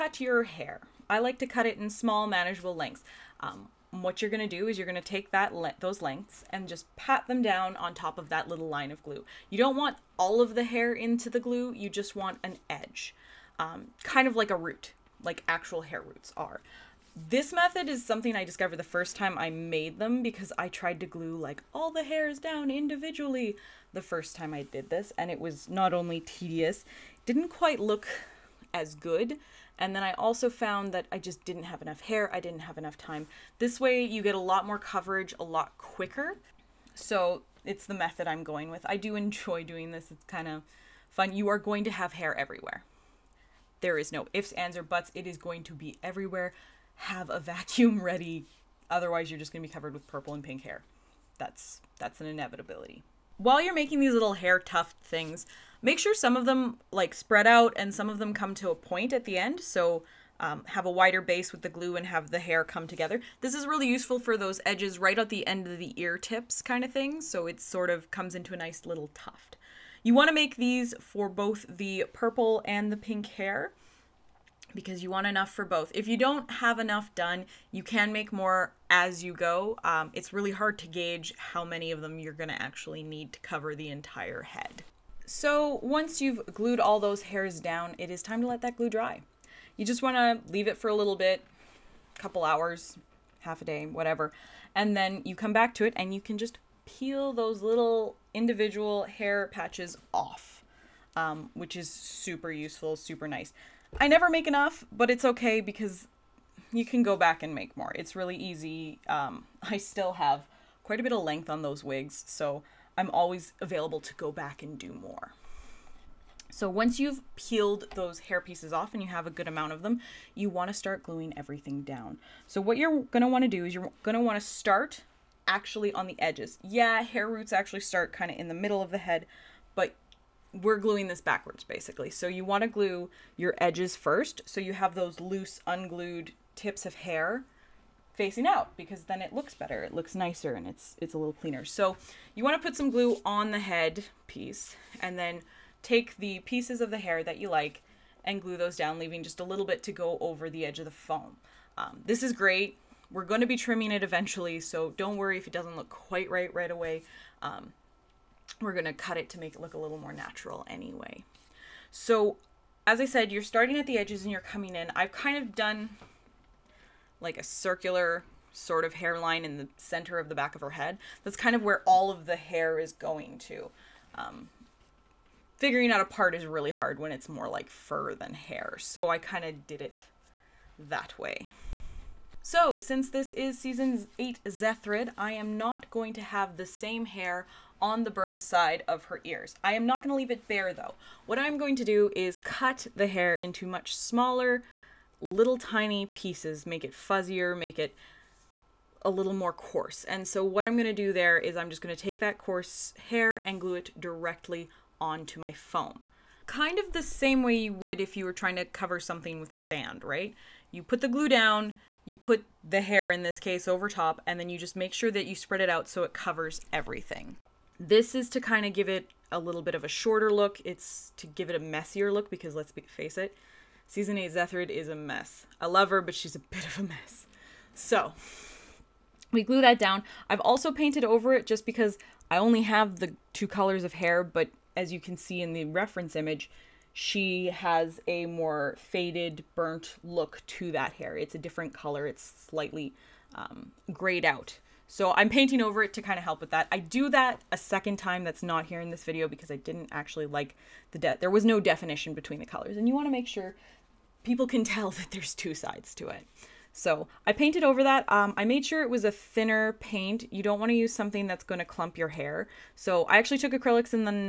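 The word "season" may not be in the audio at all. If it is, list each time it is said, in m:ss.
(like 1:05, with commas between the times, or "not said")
3:03, 3:43.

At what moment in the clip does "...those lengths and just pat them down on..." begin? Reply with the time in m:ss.
0:05.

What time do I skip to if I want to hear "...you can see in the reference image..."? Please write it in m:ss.
3:54.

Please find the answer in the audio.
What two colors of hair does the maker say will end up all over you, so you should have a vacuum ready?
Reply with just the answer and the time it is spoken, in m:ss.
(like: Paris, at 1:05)
purple and pink, at 0:50.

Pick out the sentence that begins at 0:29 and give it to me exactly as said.
And then I also found that I just didn't have enough hair, I didn't have enough time.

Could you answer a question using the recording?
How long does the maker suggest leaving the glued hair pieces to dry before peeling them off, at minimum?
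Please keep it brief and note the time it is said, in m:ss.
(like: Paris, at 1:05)
a couple hours, at 1:32.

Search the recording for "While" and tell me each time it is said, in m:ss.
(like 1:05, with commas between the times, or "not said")
0:53.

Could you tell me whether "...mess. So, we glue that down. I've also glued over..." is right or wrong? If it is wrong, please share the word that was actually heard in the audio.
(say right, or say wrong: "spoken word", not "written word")
wrong: "painted", not "glued".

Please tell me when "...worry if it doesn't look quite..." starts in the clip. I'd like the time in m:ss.
2:35.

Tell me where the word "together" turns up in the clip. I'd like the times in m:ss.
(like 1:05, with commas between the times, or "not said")
1:02.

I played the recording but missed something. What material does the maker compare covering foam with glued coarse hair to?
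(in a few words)
sand.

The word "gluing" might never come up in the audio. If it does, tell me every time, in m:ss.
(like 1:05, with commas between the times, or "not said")
2:01, 2:10.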